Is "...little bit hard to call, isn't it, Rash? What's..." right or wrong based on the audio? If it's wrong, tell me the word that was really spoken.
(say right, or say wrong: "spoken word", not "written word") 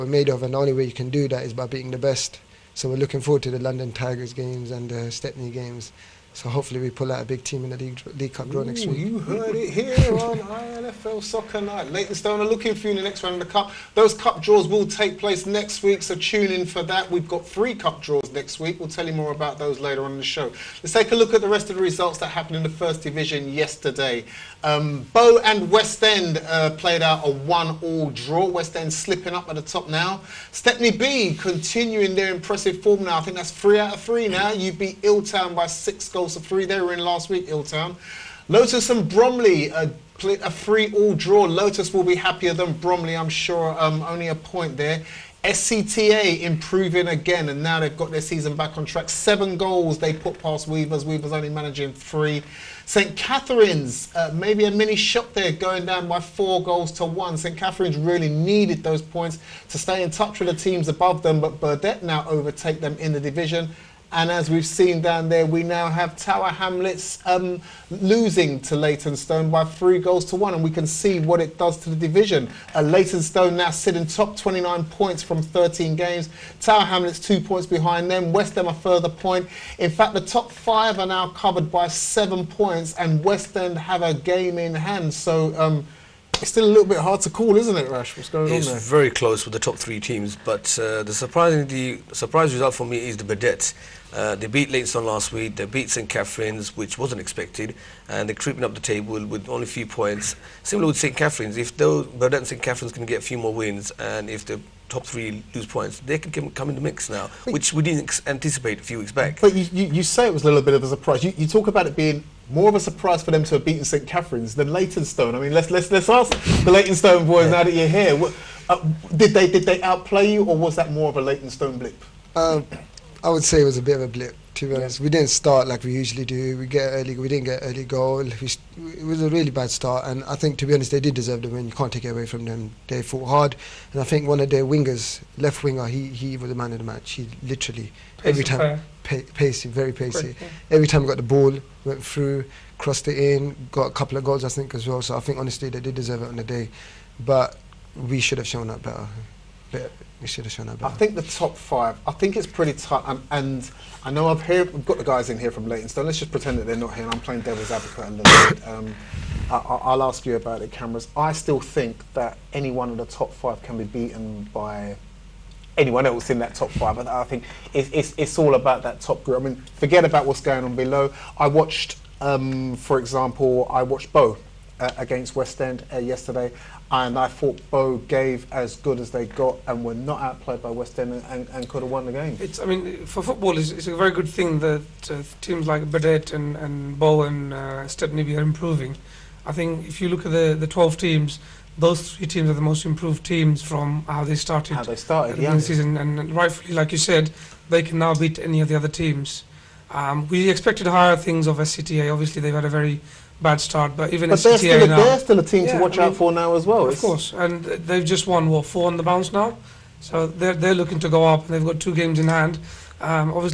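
right.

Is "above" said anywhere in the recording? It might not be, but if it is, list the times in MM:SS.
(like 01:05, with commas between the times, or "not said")
01:00.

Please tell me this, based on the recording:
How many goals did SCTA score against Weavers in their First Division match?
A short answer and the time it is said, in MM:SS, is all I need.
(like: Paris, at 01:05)
7, at 00:49.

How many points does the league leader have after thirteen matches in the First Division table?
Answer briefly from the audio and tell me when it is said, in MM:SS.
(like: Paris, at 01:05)
29, at 01:14.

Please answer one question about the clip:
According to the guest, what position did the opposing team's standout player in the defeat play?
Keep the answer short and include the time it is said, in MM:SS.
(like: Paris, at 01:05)
Left winger, at 02:15.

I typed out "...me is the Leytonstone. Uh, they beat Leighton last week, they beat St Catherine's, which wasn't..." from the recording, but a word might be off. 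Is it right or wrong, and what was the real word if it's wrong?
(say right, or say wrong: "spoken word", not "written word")
wrong: "Burdetts", not "Leytonstone".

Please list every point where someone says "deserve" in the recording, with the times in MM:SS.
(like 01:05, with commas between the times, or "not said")
02:11, 02:25.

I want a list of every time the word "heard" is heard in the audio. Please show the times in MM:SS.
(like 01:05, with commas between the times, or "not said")
00:09, 02:34.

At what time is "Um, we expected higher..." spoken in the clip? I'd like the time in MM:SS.
03:19.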